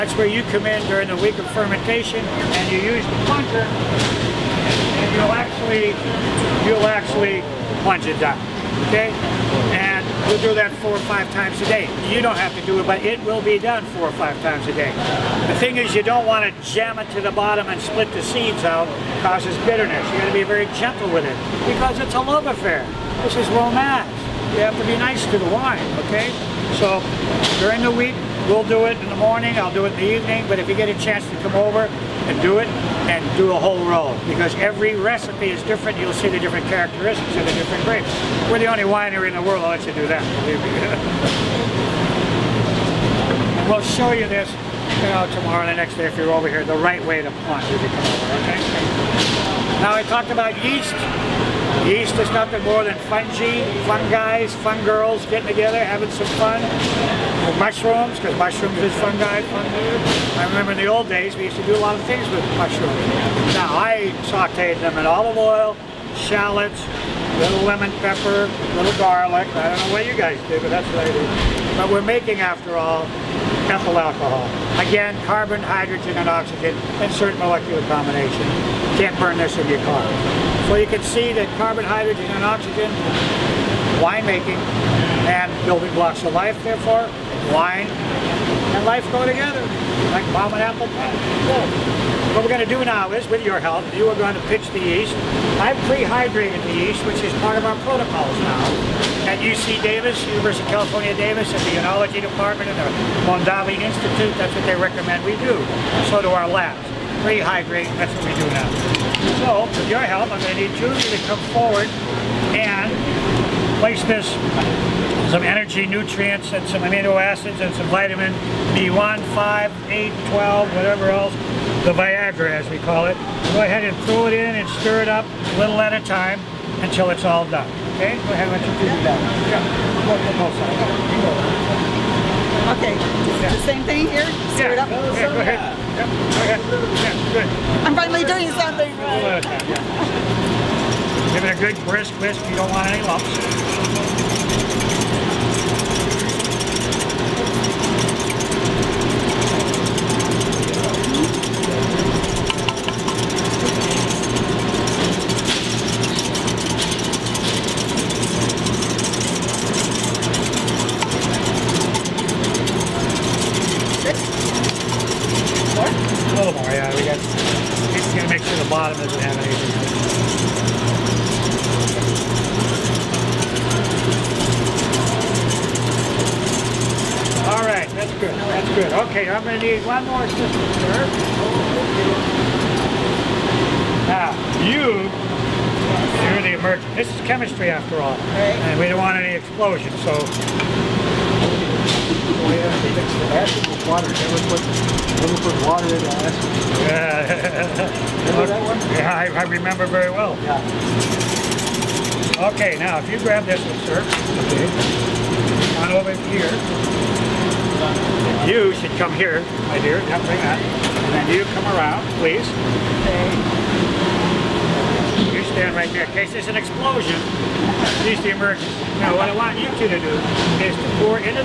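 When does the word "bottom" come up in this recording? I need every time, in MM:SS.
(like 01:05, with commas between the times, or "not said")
00:17, 02:48.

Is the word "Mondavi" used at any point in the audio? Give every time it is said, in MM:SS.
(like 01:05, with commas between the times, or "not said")
01:43.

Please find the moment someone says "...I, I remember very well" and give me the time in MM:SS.
03:19.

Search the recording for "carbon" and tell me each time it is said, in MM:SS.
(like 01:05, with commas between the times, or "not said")
01:15, 01:21.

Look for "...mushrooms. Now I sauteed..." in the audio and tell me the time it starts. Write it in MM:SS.
01:02.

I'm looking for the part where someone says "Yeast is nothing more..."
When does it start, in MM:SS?
00:51.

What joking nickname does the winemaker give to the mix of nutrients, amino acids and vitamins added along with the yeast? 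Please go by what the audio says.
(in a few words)
the Viagra.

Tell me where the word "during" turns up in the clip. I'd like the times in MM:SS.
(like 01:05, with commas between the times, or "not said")
00:00, 00:27.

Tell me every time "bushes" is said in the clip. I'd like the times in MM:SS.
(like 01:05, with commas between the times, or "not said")
not said.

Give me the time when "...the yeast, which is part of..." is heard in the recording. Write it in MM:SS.
01:36.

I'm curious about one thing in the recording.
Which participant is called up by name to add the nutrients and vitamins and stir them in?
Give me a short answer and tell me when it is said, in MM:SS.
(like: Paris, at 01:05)
Julie, at 01:50.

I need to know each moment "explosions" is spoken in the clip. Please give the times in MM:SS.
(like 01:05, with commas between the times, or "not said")
03:09, 03:36.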